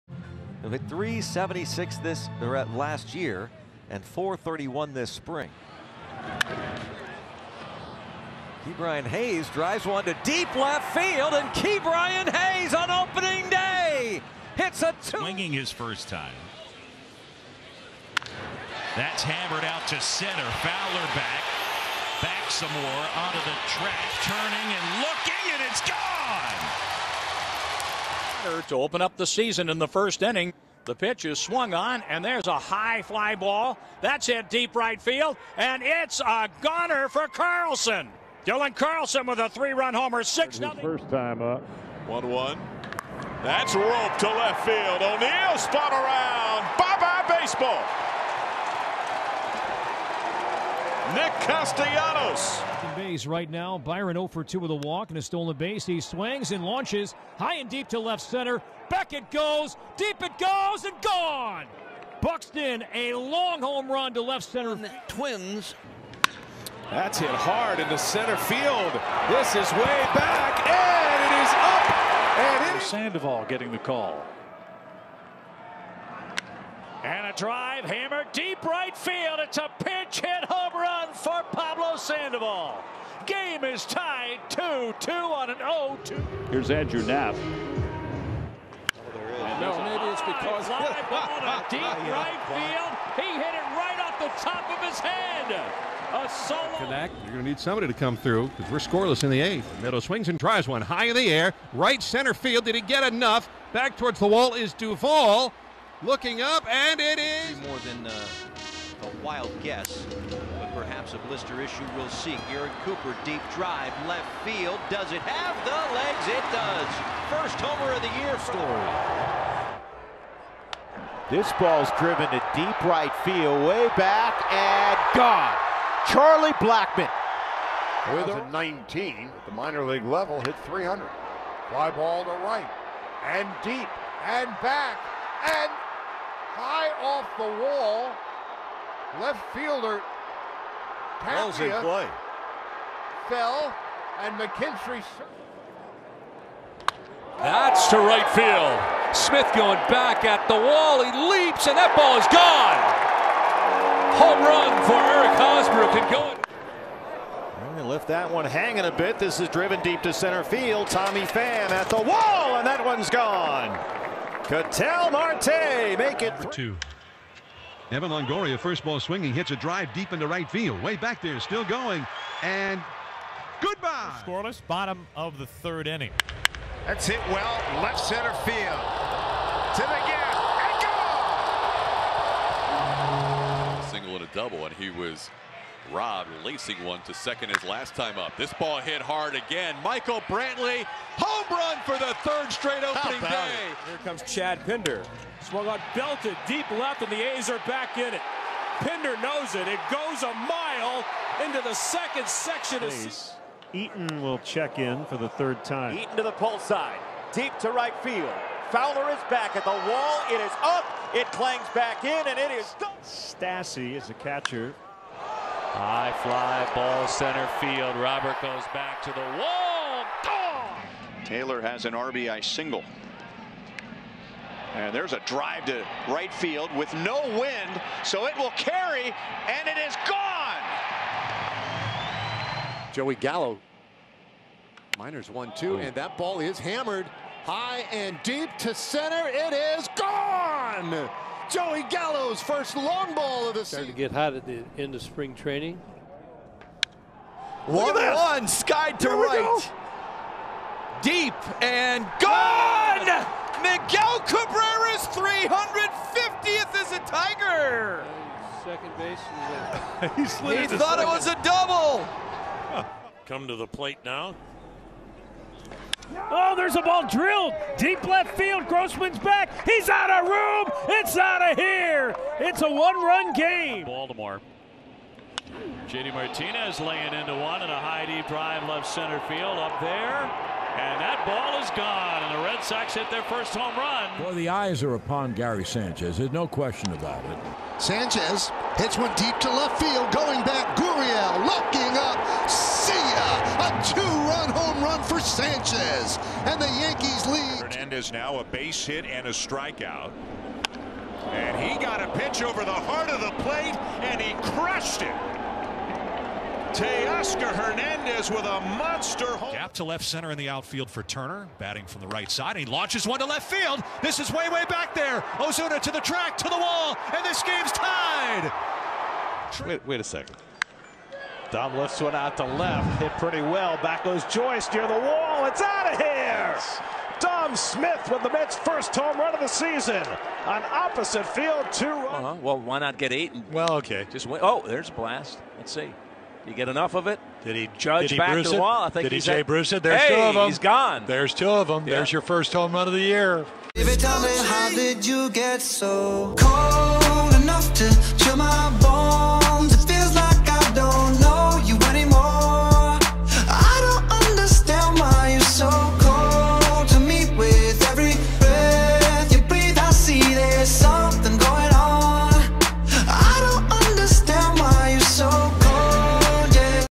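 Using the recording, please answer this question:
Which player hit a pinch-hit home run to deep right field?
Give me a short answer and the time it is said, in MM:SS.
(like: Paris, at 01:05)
Pablo Sandoval, at 01:21.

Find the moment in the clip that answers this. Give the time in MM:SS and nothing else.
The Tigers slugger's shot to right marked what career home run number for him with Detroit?
04:15.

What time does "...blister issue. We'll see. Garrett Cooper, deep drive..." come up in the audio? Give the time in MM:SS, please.
01:51.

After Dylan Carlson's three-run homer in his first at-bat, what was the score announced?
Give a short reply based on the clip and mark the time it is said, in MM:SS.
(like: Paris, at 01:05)
6-0, at 00:40.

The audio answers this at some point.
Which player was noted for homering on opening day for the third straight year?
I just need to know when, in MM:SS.
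03:09.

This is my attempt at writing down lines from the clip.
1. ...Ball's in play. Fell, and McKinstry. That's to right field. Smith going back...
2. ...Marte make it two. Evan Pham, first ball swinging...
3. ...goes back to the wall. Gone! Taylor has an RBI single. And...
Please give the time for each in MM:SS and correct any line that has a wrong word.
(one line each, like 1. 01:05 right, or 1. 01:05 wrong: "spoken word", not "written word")
1. 02:21 right
2. 02:45 wrong: "Longoria", not "Pham"
3. 03:38 right.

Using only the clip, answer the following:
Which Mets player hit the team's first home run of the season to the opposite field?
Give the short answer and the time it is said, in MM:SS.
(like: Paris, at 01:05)
Dom Smith, at 05:27.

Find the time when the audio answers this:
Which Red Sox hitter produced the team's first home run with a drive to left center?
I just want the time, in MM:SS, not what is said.
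04:35.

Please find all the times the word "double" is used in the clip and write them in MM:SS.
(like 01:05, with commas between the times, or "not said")
03:04, 04:21.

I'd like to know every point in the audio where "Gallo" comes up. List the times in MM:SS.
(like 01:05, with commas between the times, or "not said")
03:53, 04:01.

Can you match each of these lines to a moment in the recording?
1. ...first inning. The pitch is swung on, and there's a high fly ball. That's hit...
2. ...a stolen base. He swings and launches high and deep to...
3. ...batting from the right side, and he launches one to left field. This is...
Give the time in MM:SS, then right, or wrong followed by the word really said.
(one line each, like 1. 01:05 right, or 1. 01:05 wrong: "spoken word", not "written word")
1. 00:29 right
2. 00:55 right
3. 05:11 right.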